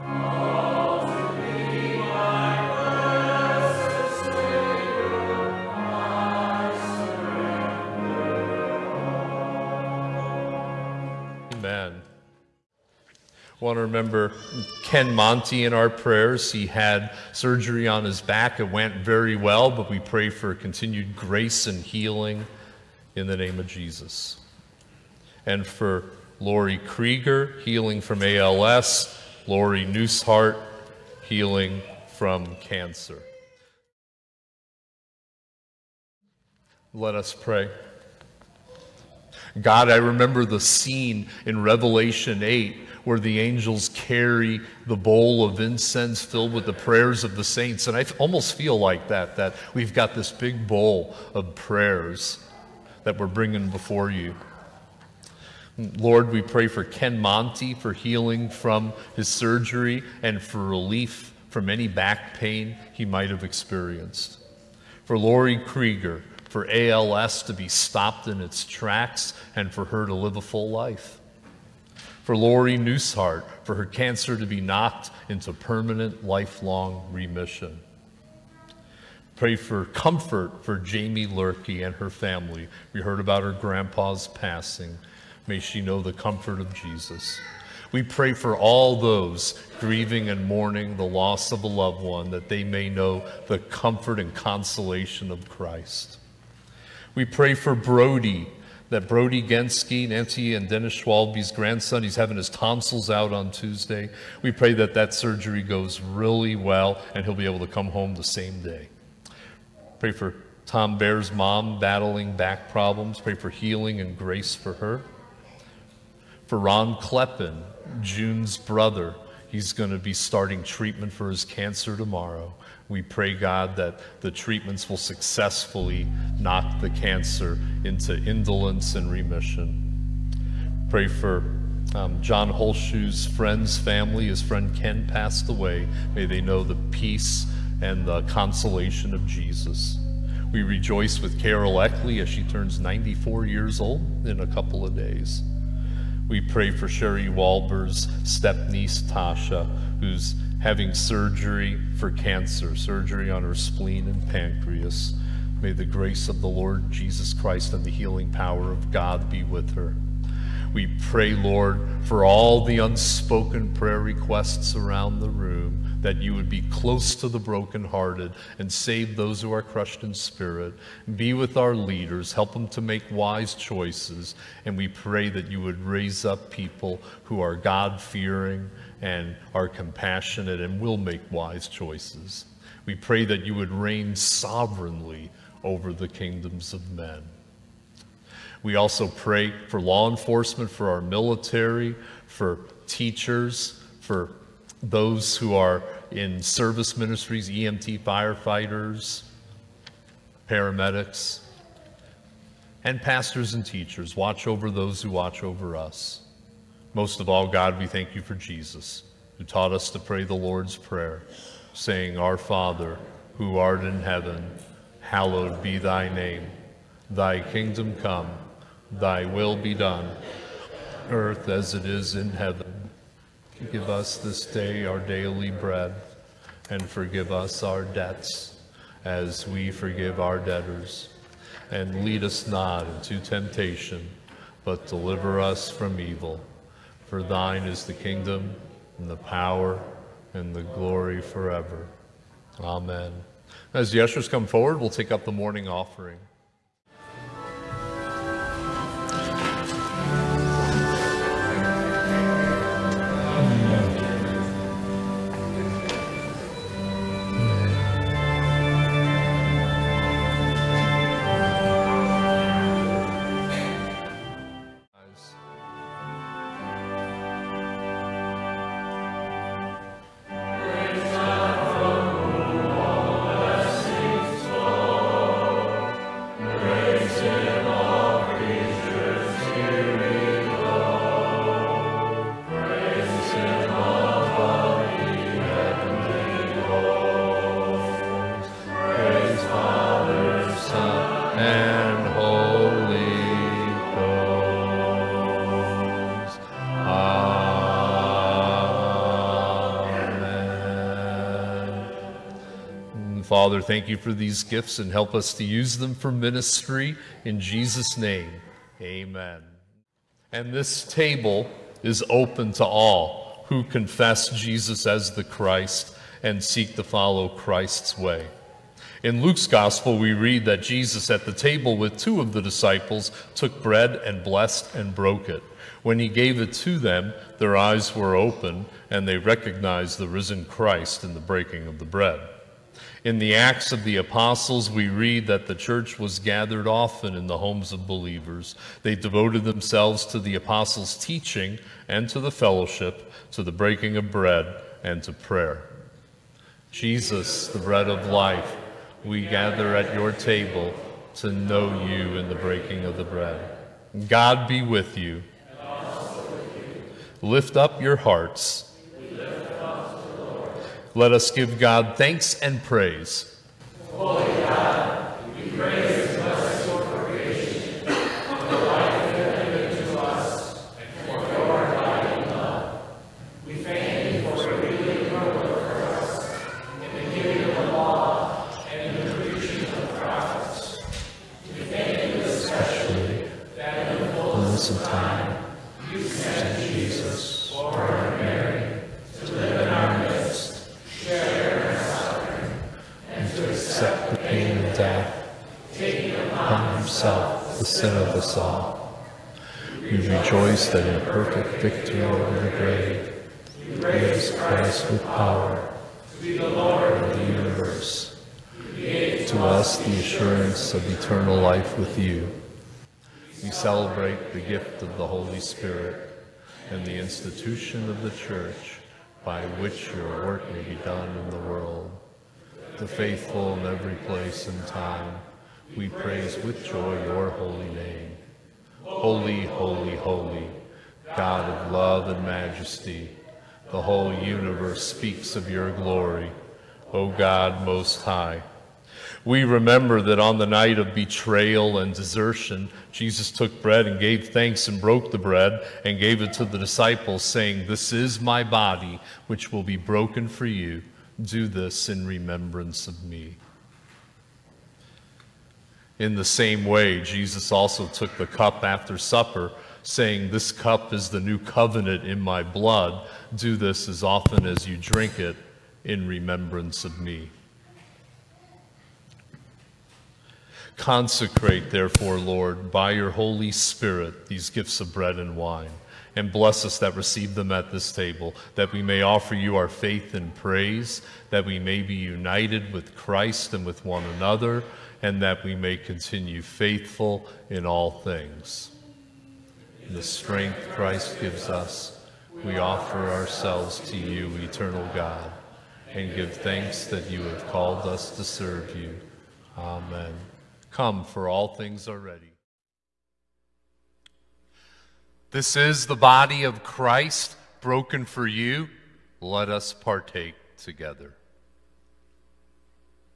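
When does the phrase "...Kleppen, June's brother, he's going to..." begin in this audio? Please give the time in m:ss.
1:56.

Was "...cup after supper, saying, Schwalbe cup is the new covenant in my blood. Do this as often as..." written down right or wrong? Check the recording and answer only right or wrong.
wrong.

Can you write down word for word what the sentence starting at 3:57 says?
For thine is the kingdom, and the power, and the glory forever.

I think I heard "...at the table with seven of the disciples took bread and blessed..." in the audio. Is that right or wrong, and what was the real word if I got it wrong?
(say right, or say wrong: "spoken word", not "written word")
wrong: "two", not "seven".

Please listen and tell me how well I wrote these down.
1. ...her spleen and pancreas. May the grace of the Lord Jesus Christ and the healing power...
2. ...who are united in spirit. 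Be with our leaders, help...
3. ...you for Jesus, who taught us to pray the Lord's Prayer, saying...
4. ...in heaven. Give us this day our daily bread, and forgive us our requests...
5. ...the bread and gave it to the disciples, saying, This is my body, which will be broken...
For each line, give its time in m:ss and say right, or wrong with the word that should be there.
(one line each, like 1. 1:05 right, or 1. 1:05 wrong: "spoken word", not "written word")
1. 2:33 right
2. 2:49 wrong: "crushed", not "united"
3. 3:28 right
4. 3:42 wrong: "debts", not "requests"
5. 7:25 right.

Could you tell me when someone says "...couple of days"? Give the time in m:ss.
2:24.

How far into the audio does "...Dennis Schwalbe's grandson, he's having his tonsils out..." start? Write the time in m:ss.
1:40.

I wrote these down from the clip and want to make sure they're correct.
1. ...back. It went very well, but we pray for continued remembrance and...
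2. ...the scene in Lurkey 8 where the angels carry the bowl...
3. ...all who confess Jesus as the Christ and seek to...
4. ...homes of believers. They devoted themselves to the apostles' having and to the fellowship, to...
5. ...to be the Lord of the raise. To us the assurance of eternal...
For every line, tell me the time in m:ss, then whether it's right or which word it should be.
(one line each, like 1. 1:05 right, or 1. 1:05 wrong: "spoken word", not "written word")
1. 0:18 wrong: "grace", not "remembrance"
2. 0:40 wrong: "Revelation", not "Lurkey"
3. 5:12 right
4. 5:37 wrong: "teaching", not "having"
5. 6:46 wrong: "universe", not "raise".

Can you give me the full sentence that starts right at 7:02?
The faithful in every place and time, we praise with joy your holy name.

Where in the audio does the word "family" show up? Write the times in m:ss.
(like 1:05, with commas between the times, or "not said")
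1:22, 2:13.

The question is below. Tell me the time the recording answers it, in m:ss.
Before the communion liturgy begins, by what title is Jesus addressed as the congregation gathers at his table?
5:47.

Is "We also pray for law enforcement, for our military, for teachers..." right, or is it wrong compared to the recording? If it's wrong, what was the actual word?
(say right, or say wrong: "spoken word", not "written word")
right.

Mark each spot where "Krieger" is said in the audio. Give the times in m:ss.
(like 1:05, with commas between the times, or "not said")
0:26, 1:05.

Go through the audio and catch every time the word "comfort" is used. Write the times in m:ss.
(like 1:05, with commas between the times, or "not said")
1:19, 1:26, 1:33.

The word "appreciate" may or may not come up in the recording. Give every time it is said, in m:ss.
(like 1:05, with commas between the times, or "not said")
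not said.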